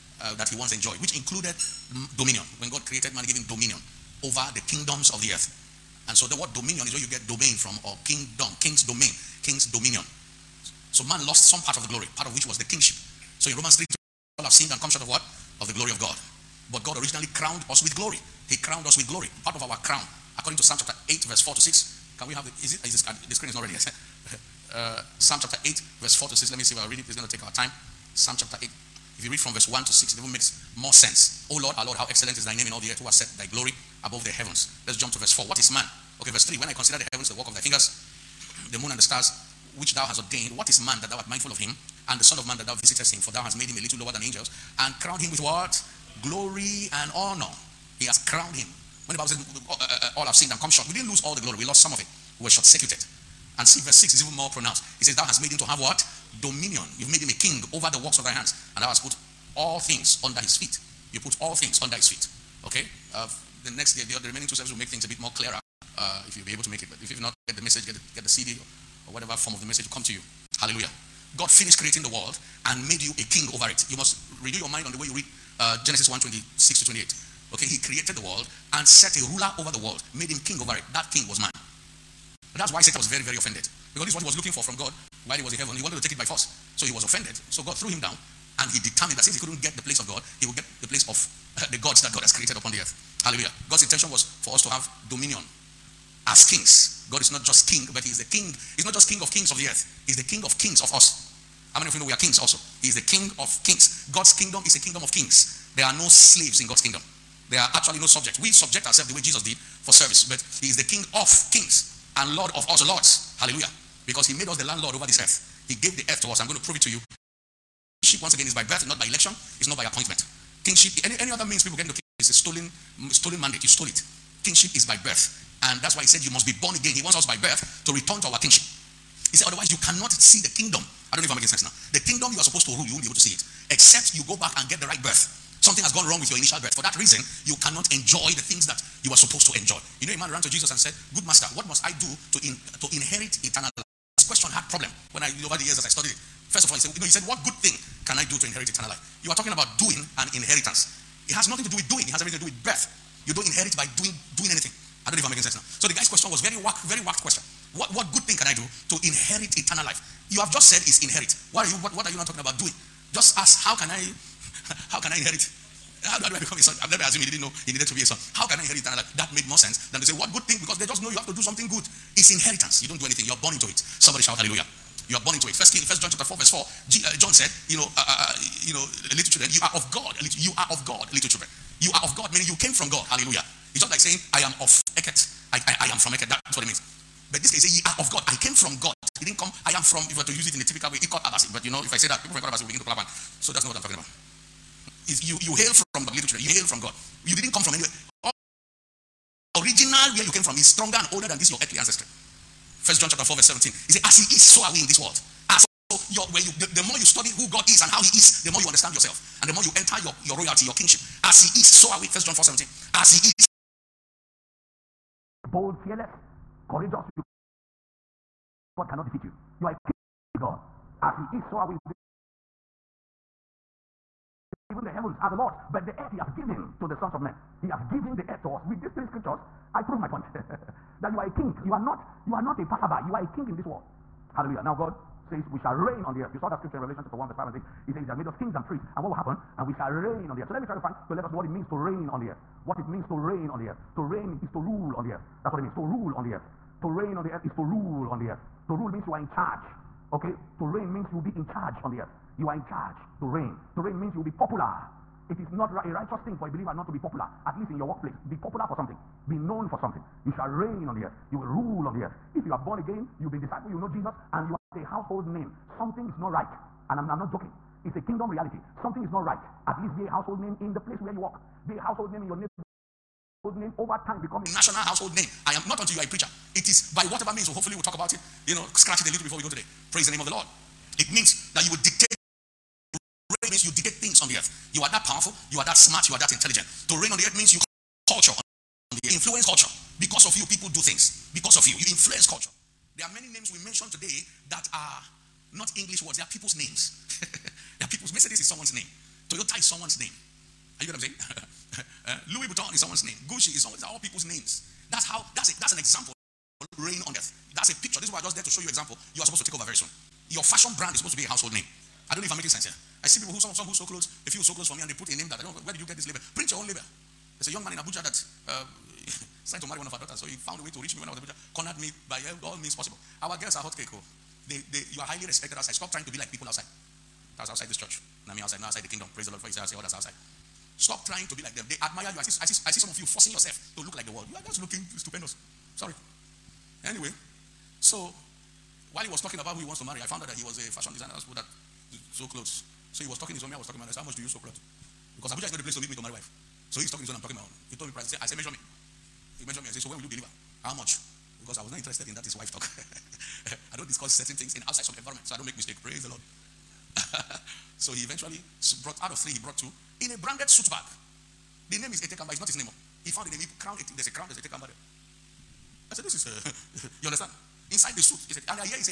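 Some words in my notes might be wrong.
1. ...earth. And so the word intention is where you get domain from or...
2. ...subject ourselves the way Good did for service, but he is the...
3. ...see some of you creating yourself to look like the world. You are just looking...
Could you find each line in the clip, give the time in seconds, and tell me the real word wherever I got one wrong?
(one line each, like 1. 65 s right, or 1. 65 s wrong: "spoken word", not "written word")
1. 5 s wrong: "dominion", not "intention"
2. 108 s wrong: "Jesus", not "Good"
3. 332 s wrong: "forcing", not "creating".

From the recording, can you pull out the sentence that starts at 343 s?
I said, "How much do you sew clothes?" Because Abuja is not the place to meet me to marry wife.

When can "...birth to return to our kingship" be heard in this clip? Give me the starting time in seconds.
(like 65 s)
127 s.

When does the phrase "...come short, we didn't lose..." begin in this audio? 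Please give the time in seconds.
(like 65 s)
50 s.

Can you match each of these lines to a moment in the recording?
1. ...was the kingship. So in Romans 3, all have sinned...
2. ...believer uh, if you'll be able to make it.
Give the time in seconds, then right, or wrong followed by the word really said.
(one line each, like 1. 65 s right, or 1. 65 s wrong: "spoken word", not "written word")
1. 12 s right
2. 65 s wrong: "clearer", not "believer".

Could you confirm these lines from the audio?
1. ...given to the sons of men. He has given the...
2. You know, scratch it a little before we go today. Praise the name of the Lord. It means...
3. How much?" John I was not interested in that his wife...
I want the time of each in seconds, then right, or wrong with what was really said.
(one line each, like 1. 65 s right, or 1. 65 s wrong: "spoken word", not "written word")
1. 226 s right
2. 278 s right
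3. 350 s wrong: "Because", not "John".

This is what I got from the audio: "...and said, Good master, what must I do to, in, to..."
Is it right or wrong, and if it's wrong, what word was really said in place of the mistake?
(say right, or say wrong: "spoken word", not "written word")
right.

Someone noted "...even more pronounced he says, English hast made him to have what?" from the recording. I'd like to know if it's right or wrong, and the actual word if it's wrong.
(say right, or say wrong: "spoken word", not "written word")
wrong: "Thou", not "English".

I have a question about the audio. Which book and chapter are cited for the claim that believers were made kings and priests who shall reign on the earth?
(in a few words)
Revelation 1.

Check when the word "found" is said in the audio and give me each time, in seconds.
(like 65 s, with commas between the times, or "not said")
320 s, 340 s, 363 s.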